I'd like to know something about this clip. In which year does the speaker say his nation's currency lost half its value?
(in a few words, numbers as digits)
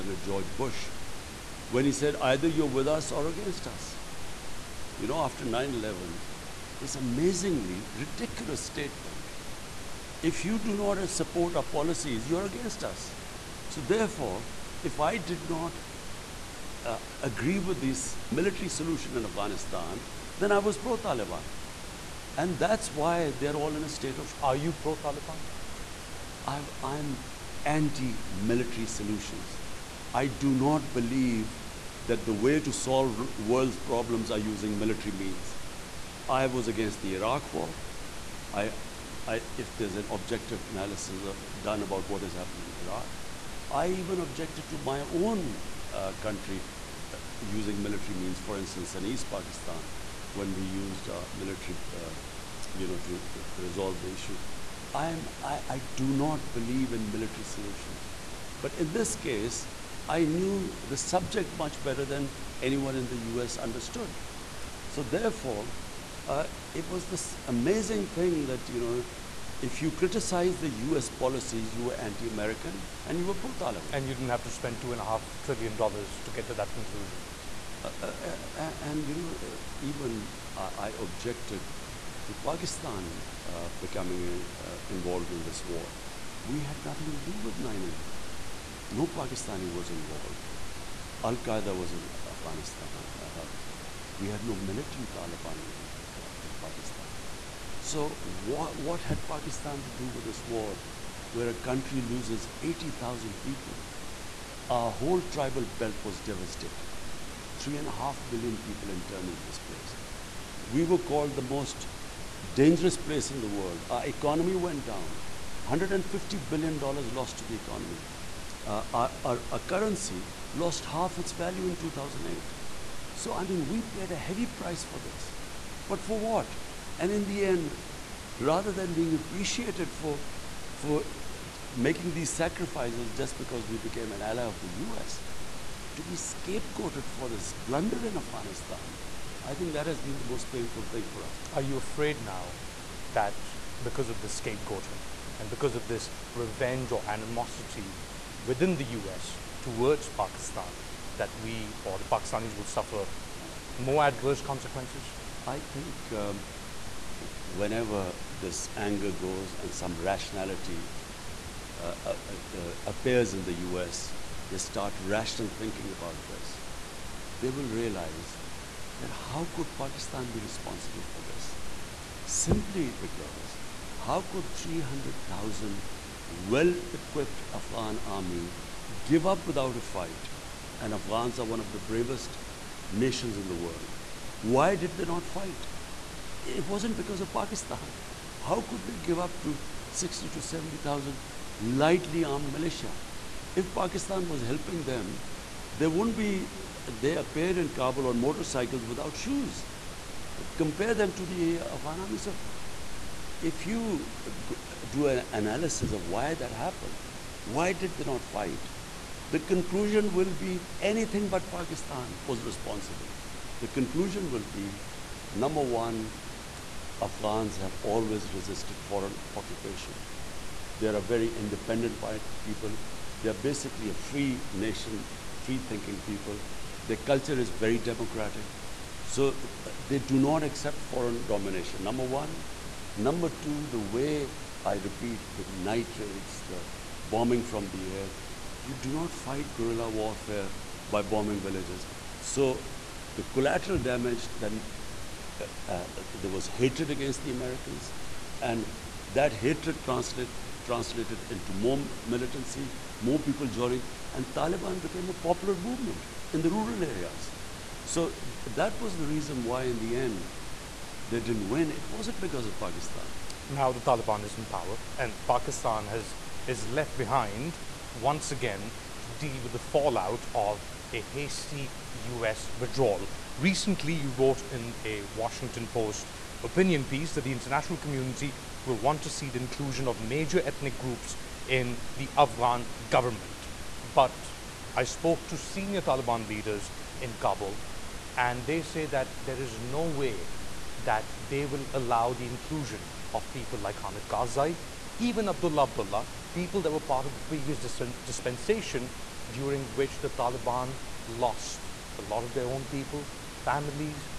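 2008.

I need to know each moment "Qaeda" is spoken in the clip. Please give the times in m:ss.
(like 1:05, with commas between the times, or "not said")
1:31.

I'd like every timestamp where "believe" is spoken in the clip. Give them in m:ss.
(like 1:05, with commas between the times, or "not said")
0:30, 0:56.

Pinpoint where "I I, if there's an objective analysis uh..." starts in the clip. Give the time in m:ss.
0:38.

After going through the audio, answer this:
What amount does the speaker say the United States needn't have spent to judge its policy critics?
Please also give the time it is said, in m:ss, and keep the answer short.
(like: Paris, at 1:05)
$2.5 trillion, at 1:14.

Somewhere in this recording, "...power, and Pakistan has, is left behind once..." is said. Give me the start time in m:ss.
4:24.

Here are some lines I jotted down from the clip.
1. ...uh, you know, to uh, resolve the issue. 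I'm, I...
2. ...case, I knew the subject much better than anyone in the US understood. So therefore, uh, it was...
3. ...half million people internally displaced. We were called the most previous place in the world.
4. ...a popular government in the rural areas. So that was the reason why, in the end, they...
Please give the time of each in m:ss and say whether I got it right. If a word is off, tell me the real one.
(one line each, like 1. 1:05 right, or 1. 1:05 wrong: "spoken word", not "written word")
1. 0:51 right
2. 0:59 right
3. 1:47 wrong: "dangerous", not "previous"
4. 4:15 wrong: "movement", not "government".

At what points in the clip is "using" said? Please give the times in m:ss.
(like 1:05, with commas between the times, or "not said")
0:34, 0:47.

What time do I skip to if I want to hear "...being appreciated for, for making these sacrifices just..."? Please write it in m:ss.
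2:08.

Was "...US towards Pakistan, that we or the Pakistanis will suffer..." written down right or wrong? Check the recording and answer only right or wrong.
right.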